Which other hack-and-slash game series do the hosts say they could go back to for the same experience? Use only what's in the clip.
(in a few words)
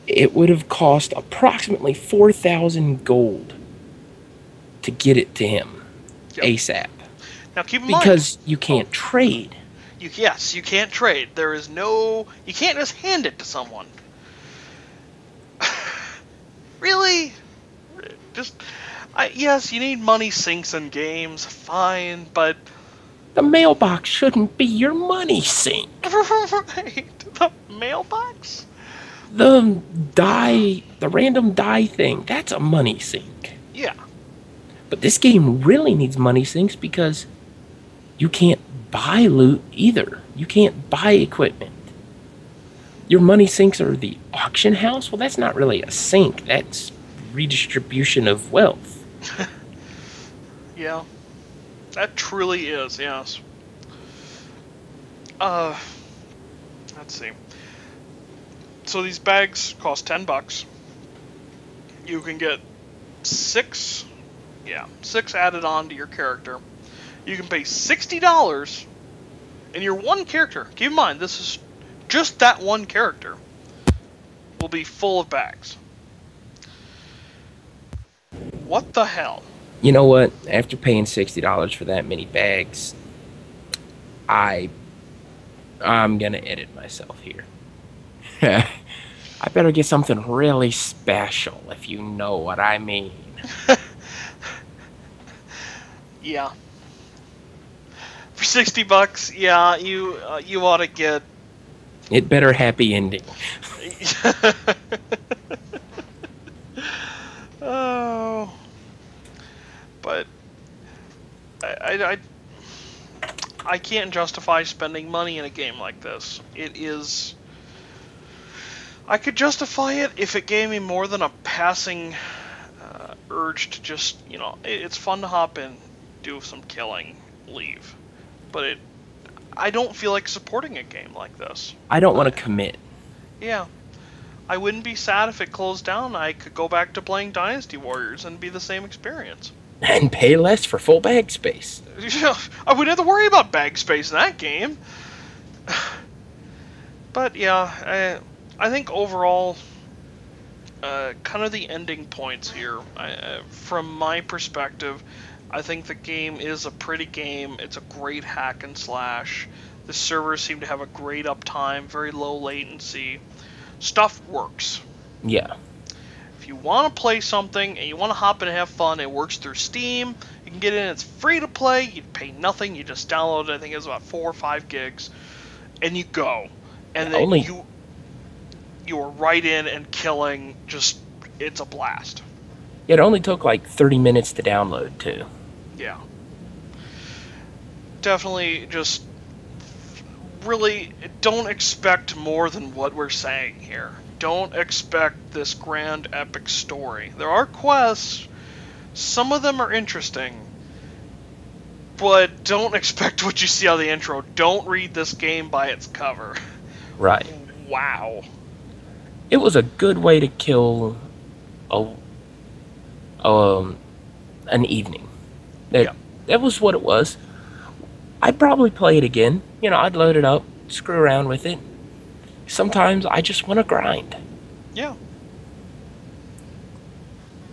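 Dynasty Warriors.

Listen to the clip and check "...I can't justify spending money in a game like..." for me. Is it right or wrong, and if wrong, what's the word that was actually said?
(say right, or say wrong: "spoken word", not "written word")
right.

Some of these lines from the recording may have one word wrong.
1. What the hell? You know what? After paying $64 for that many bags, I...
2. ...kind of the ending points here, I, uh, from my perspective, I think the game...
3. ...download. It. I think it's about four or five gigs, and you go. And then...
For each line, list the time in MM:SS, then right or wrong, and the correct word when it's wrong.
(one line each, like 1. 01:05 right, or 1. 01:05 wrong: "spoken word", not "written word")
1. 01:18 wrong: "60", not "64"
2. 02:31 right
3. 02:53 right.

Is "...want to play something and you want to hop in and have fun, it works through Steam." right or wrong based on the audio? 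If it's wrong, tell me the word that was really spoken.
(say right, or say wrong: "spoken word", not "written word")
right.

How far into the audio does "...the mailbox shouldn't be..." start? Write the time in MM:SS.
00:23.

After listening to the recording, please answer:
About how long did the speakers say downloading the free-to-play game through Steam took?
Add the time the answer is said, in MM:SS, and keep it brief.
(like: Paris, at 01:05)
30 minutes, at 03:03.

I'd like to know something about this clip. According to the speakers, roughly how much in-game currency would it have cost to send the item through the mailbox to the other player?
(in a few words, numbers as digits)
4,000 gold.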